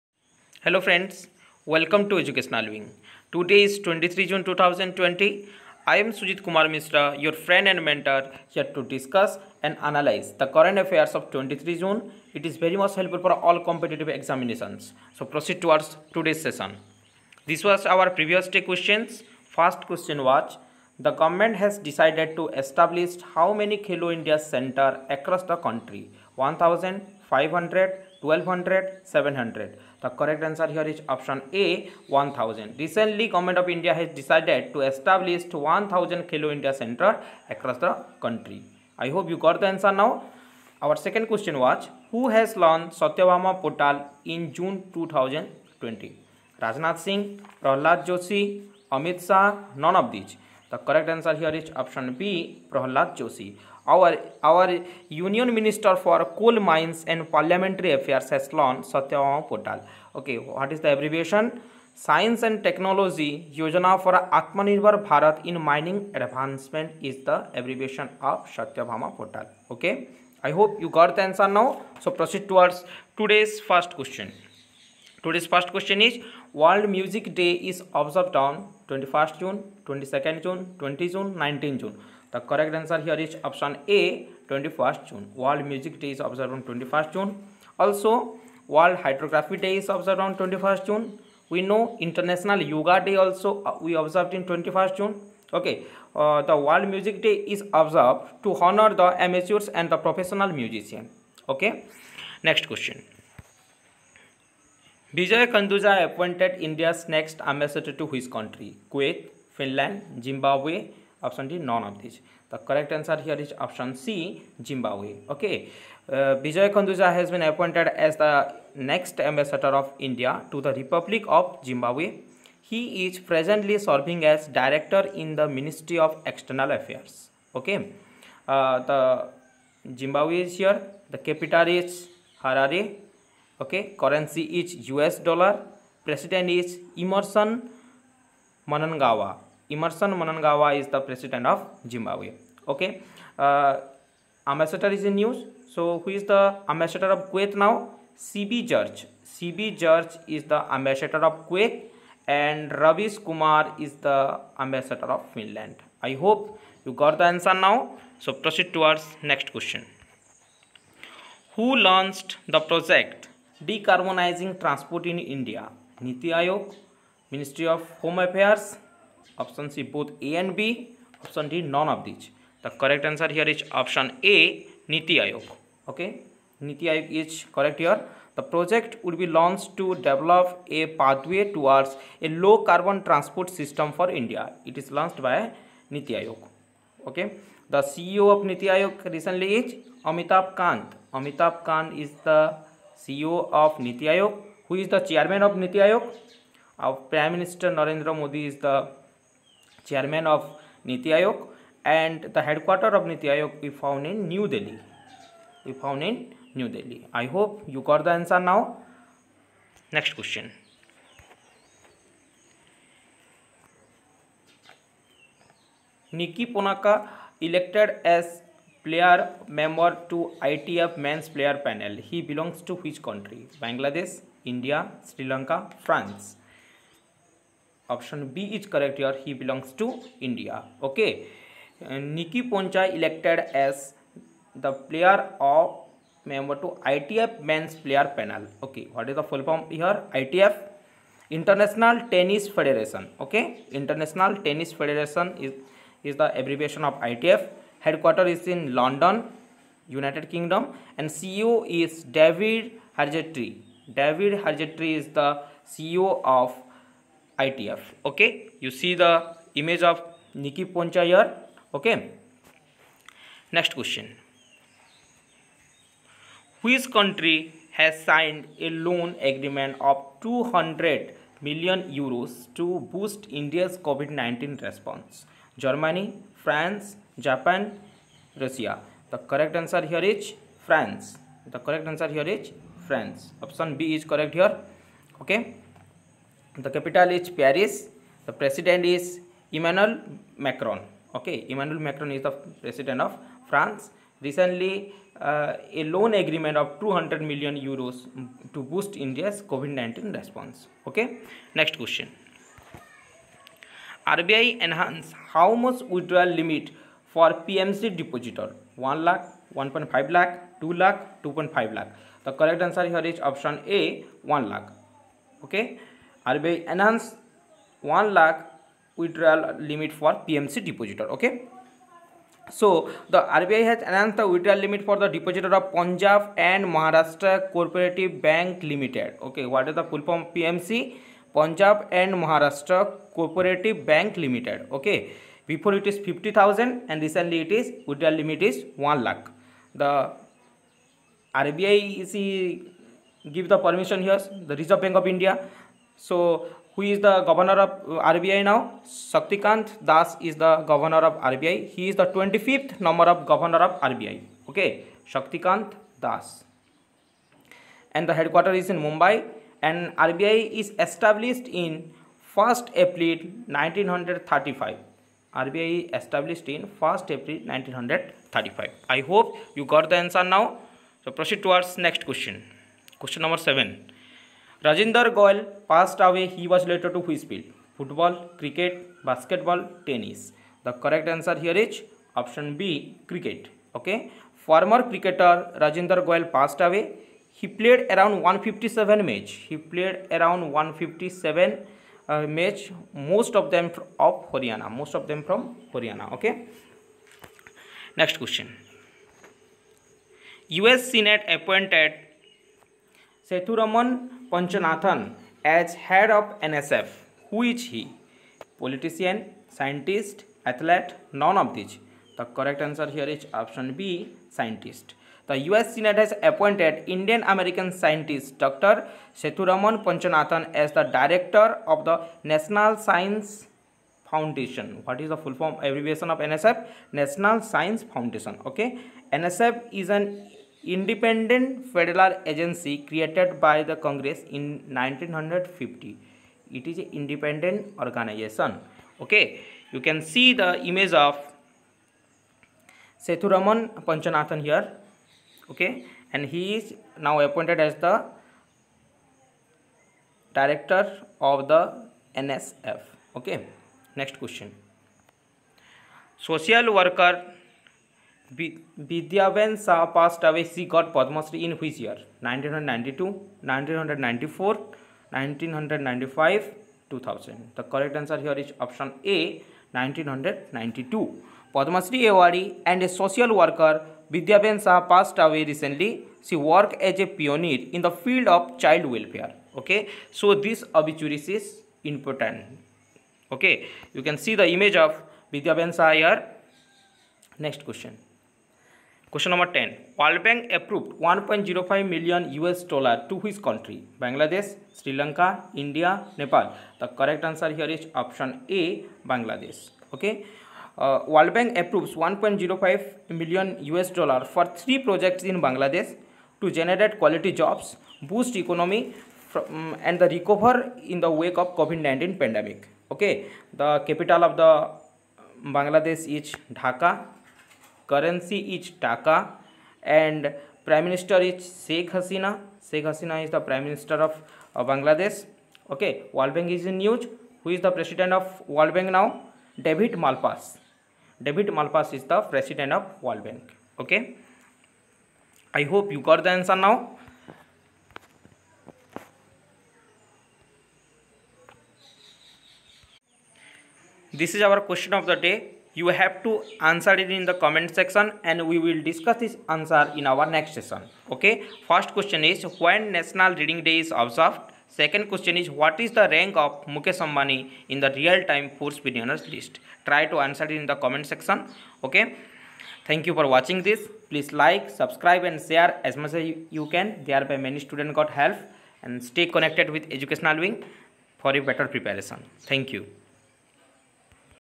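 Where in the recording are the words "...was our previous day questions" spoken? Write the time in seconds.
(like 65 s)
17 s.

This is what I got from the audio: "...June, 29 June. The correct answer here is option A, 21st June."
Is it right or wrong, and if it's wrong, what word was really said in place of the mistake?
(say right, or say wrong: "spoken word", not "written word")
wrong: "19", not "29".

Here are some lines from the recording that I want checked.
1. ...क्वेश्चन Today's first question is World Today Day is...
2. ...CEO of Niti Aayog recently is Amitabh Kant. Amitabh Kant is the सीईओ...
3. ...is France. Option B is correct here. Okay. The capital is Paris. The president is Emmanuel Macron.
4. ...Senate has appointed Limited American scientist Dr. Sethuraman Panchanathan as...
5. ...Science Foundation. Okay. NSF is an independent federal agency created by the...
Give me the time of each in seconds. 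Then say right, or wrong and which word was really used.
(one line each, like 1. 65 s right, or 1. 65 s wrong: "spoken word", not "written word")
1. 73 s wrong: "Music", not "Today"
2. 187 s right
3. 282 s right
4. 415 s wrong: "Indian", not "Limited"
5. 427 s right.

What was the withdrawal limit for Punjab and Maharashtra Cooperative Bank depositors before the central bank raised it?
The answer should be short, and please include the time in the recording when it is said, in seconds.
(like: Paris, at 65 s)
50000, at 336 s.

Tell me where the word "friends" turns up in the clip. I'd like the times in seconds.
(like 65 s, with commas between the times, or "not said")
0 s, 7 s.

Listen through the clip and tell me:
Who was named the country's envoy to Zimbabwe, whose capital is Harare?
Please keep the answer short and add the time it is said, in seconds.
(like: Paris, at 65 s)
Vijay Kanduja, at 105 s.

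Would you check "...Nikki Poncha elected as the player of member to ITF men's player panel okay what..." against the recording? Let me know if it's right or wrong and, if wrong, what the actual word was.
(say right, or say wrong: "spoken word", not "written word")
right.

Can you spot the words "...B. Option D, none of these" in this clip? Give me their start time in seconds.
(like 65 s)
170 s.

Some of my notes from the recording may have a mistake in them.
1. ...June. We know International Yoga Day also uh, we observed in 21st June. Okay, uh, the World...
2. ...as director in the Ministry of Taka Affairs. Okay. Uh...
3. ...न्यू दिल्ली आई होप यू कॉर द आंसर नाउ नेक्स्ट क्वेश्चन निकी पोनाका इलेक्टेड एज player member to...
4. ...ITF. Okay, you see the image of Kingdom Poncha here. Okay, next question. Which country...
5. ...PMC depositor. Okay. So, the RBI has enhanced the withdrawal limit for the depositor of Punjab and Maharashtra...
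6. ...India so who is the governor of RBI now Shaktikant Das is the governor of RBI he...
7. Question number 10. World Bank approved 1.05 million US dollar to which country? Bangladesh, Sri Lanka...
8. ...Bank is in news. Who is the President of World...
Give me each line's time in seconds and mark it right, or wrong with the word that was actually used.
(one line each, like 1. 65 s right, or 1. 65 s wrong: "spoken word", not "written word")
1. 90 s right
2. 124 s wrong: "External", not "Taka"
3. 206 s right
4. 257 s wrong: "Nikki", not "Kingdom"
5. 320 s right
6. 345 s right
7. 489 s right
8. 526 s right.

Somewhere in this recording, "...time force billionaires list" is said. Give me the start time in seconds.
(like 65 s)
558 s.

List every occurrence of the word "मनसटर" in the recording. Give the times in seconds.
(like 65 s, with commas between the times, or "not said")
55 s, 197 s.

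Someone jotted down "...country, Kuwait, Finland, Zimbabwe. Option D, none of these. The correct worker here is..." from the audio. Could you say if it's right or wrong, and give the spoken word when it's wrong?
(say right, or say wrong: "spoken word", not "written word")
wrong: "answer", not "worker".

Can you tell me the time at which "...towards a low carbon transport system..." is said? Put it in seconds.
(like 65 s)
181 s.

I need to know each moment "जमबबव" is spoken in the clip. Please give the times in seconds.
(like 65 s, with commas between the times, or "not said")
141 s.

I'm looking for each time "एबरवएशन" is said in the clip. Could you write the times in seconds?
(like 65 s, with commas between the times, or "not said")
60 s, 67 s.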